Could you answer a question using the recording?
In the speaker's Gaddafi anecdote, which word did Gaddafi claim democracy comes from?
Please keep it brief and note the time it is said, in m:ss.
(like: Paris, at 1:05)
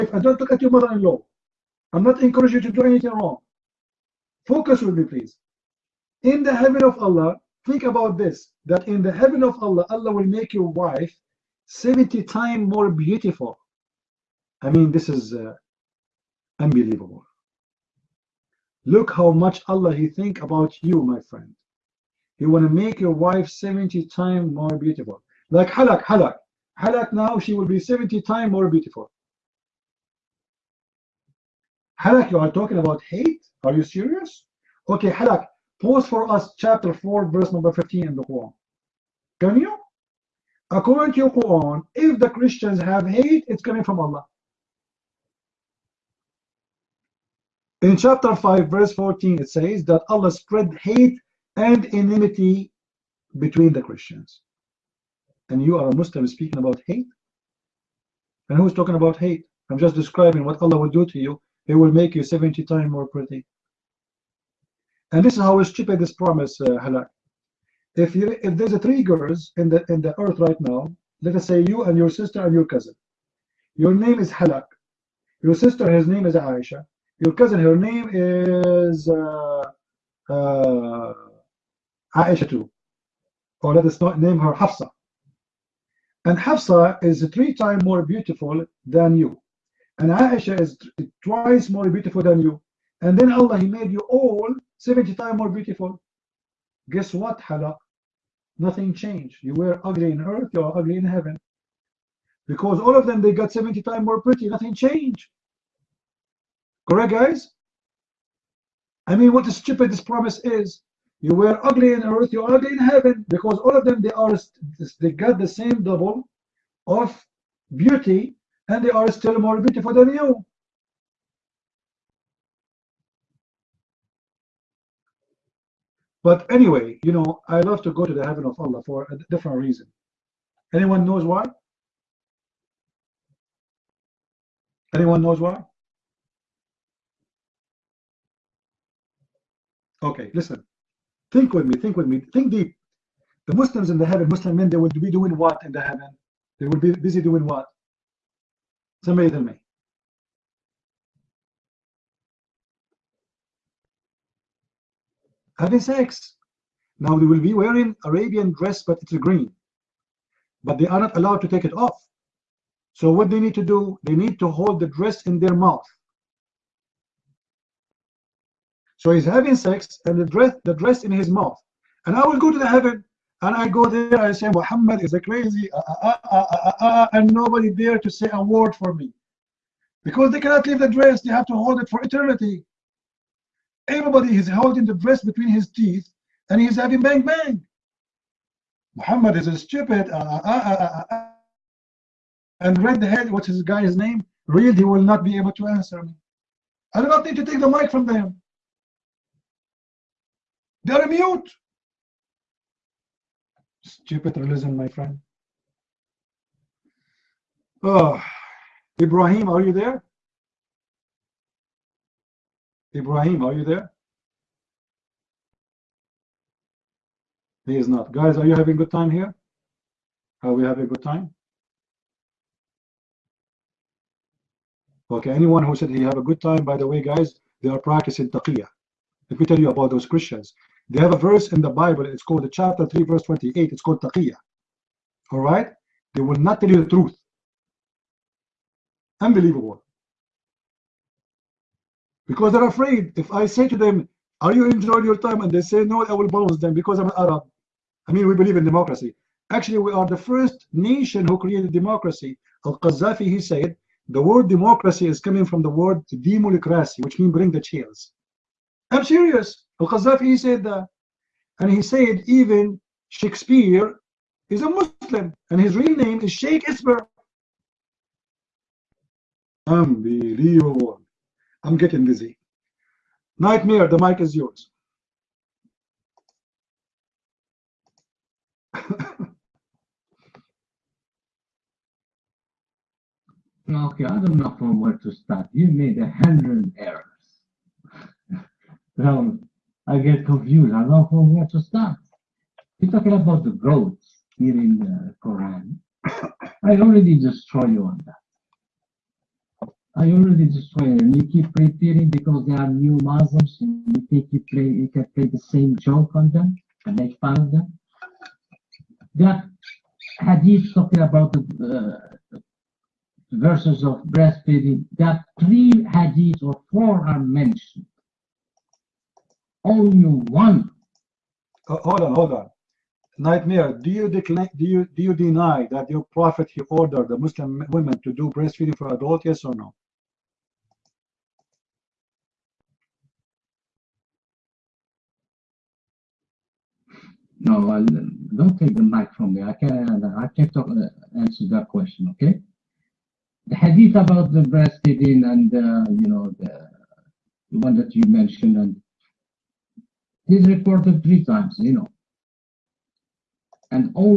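Demulikrasi, at 4:16.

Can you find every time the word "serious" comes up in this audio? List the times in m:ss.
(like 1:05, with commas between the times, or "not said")
0:33, 4:19.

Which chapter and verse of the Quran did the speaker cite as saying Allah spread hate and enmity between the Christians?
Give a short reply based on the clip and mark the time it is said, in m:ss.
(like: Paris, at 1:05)
Chapter 5, verse 14, at 0:47.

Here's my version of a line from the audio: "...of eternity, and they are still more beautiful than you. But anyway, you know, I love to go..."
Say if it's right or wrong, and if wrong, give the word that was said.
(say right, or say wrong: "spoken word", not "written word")
wrong: "beauty", not "eternity".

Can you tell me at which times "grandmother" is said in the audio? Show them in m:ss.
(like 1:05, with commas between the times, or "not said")
not said.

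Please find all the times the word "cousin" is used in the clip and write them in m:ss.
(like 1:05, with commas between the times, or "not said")
1:12, 1:17.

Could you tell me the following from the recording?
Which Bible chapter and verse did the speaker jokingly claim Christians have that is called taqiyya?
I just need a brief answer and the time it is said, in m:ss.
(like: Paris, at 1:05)
Chapter 3, verse 28, at 3:52.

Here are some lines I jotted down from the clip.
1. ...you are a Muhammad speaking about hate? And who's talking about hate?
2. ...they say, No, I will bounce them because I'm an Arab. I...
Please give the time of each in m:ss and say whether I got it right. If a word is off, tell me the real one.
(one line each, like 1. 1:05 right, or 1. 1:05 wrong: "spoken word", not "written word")
1. 0:55 wrong: "Muslim", not "Muhammad"
2. 4:05 right.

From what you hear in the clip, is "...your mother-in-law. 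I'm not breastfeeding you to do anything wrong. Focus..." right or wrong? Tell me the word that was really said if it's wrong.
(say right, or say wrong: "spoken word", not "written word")
wrong: "encouraging", not "breastfeeding".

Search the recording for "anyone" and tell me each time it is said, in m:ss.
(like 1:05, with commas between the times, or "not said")
2:10, 2:14, 3:45.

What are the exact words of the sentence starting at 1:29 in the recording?
And Aisha is twice more beautiful than you.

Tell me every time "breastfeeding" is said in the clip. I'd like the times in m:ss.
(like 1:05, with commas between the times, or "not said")
5:14, 5:28, 5:44.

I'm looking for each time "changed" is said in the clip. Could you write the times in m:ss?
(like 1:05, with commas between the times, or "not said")
1:38, 1:44.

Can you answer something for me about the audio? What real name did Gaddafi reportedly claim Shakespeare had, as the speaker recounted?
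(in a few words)
Sheikh Isber.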